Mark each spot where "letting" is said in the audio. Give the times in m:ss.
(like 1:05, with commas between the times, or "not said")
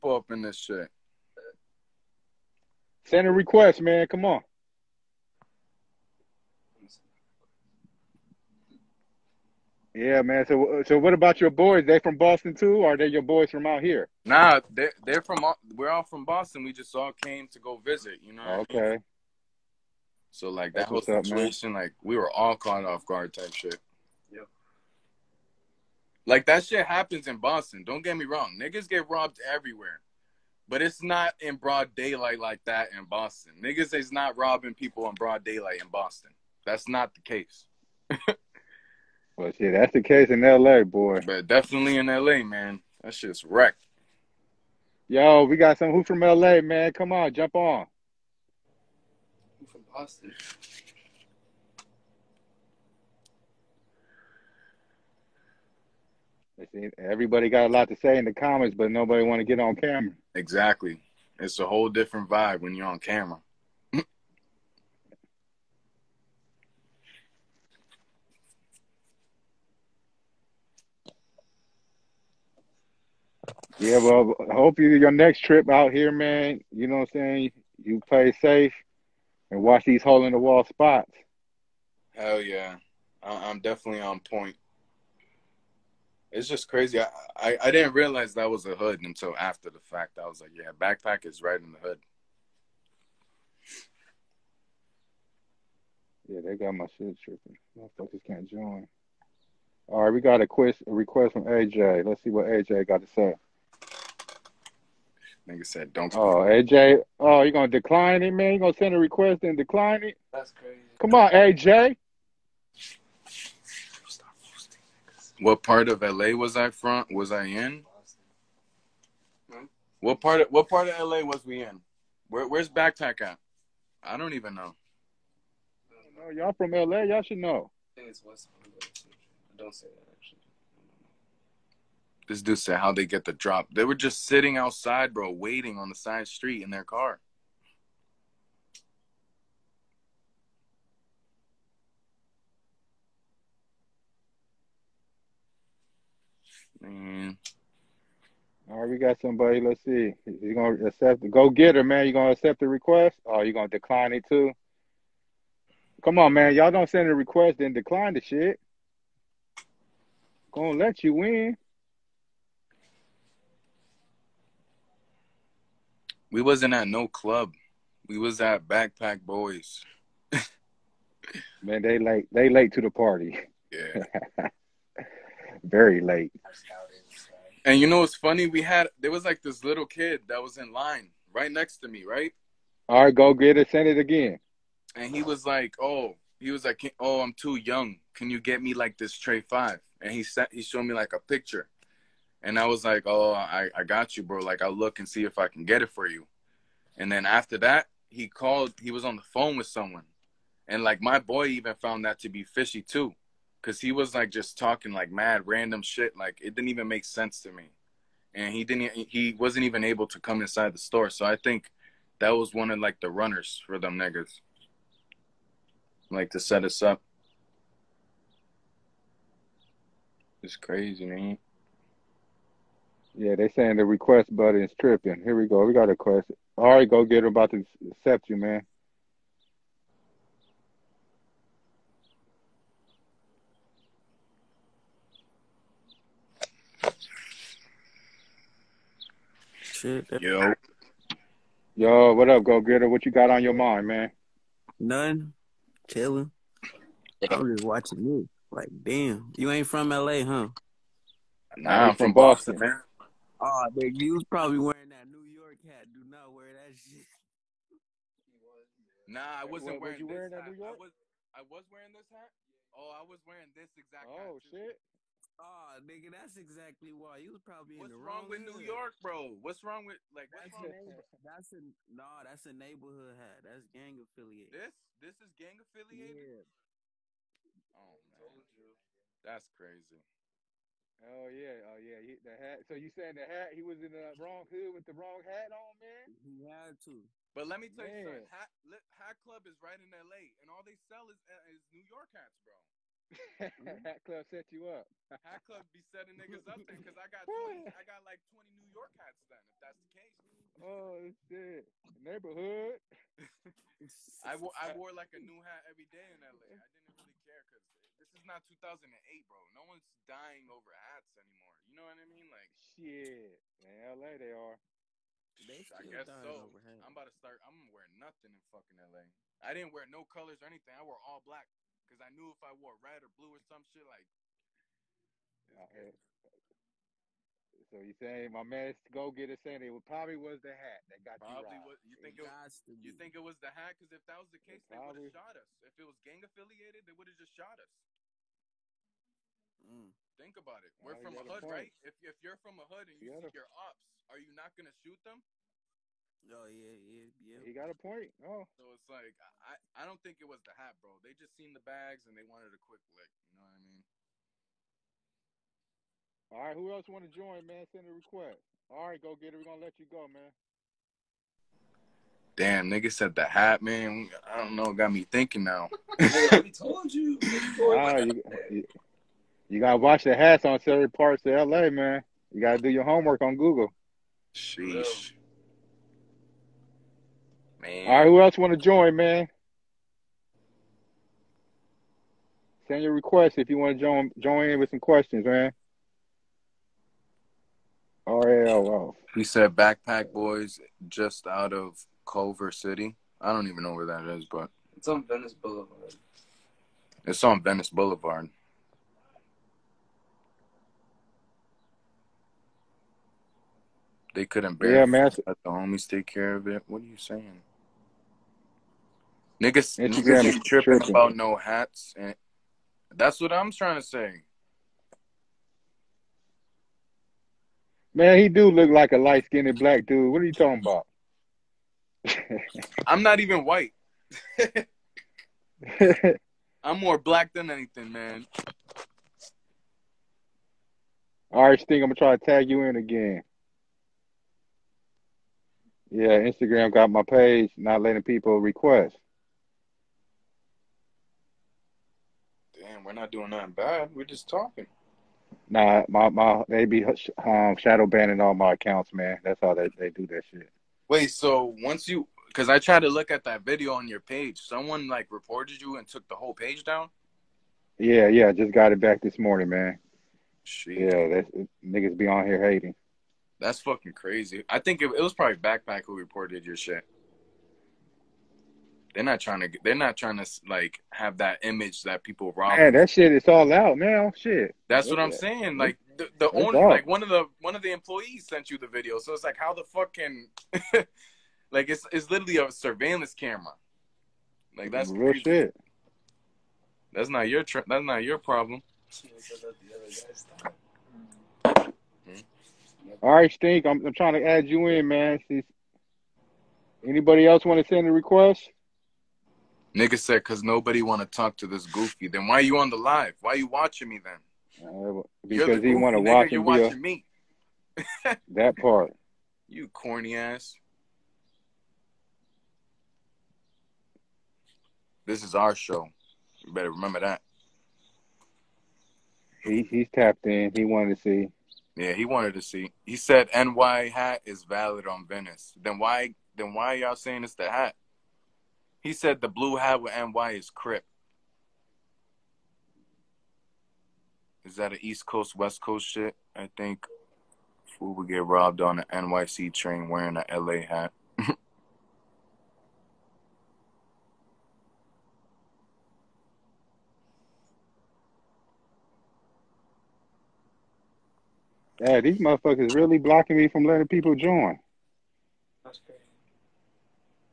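7:17, 9:13.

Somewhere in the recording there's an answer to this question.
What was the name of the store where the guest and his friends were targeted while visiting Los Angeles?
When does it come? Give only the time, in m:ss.
2:48.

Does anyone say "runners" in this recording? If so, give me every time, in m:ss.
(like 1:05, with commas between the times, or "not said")
3:33.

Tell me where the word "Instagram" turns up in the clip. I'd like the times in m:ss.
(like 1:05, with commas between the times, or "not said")
6:49, 7:16.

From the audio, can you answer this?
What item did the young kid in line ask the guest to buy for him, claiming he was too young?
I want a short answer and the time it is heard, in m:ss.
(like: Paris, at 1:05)
tray five, at 3:09.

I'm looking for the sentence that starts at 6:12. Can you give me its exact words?
You gotta do your homework on Google.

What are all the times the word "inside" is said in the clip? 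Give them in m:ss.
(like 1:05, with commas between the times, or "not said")
3:30.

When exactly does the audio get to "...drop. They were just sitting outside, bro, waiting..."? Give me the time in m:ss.
2:13.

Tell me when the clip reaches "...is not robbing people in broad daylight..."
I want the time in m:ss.
0:33.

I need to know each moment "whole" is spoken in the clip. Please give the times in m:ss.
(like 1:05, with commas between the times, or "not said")
0:21, 1:01, 7:36.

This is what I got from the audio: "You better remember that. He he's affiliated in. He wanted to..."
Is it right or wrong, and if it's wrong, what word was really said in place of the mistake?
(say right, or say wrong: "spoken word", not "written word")
wrong: "tapped", not "affiliated".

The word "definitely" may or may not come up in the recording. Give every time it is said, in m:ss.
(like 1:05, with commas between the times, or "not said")
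0:41, 1:23.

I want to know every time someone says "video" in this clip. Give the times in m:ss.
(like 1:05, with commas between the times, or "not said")
7:33, 7:58.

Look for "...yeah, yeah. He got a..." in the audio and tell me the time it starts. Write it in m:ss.
5:46.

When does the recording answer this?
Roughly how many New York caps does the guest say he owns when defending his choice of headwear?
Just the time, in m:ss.
4:58.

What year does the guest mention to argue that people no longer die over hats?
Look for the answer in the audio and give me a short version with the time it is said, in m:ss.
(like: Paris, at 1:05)
2008, at 5:08.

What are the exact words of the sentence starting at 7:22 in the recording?
damn, we're not doing nothing bad.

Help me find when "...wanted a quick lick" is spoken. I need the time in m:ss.
5:52.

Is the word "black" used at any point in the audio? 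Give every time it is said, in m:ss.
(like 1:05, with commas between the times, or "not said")
5:21, 6:59, 7:06.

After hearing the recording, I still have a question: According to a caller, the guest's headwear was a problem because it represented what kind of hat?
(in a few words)
neighborhood hat.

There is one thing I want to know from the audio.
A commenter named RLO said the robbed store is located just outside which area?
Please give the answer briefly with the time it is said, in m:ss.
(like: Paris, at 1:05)
Culver City, at 6:32.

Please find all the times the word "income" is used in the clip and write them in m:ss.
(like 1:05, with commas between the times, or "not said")
not said.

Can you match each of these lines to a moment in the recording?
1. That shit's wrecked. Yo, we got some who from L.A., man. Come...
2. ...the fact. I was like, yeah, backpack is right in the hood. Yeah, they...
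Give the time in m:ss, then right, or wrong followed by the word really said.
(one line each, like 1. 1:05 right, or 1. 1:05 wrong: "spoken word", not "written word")
1. 0:43 right
2. 1:29 right.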